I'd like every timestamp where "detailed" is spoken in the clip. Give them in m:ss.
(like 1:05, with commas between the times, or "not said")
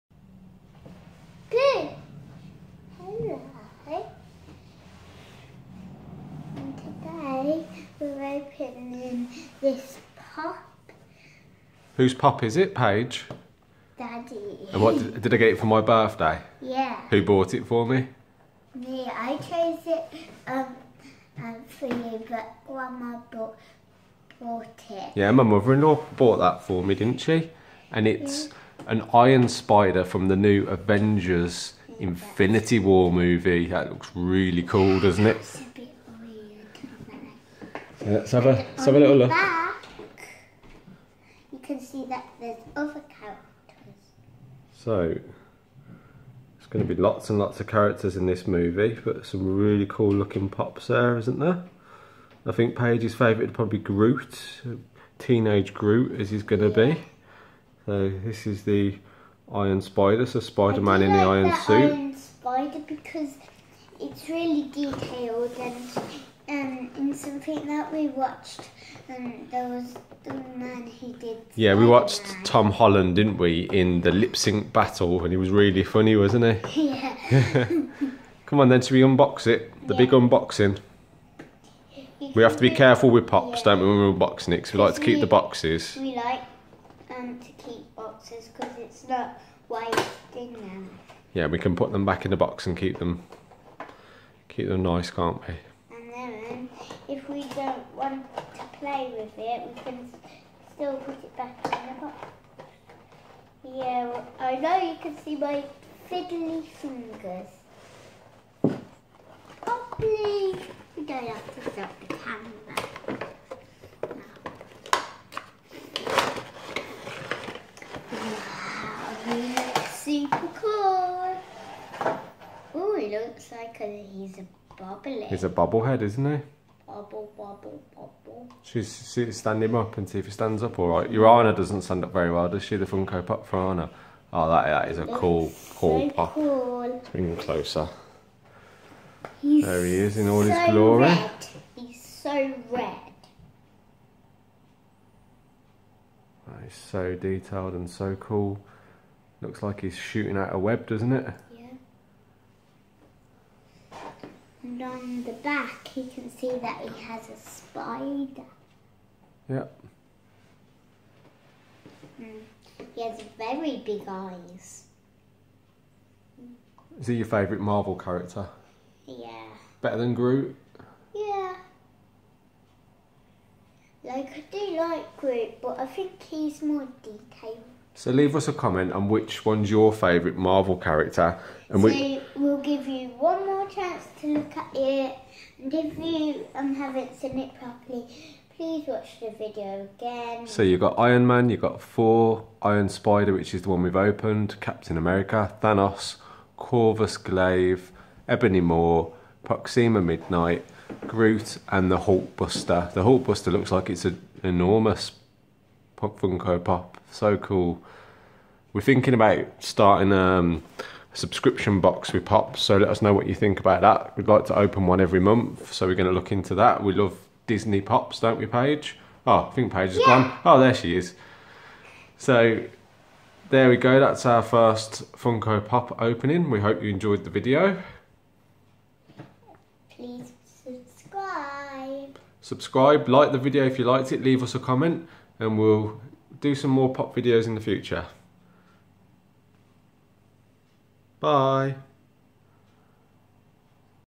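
1:04, 2:27, 2:57.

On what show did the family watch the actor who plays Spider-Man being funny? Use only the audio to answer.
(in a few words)
Lip sync battle.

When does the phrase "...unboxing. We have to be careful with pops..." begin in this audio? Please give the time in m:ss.
1:20.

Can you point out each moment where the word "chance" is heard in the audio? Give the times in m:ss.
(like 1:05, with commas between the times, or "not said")
3:03.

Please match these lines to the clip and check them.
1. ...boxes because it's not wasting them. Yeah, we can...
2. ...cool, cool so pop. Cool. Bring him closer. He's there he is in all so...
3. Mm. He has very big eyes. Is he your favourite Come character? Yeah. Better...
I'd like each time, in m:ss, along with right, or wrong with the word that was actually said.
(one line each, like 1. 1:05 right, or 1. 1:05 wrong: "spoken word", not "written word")
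1. 1:27 right
2. 2:15 right
3. 2:42 wrong: "Marvel", not "Come".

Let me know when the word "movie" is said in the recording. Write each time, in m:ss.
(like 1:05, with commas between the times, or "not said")
0:33, 0:48.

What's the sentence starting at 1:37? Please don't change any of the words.
if we don't want to play with it, we can still put it back in the box.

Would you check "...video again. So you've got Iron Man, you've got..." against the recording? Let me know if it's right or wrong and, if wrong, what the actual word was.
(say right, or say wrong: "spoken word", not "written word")
right.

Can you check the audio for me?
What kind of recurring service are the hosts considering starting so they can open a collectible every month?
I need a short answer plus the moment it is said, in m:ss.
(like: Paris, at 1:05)
A subscription box, at 3:31.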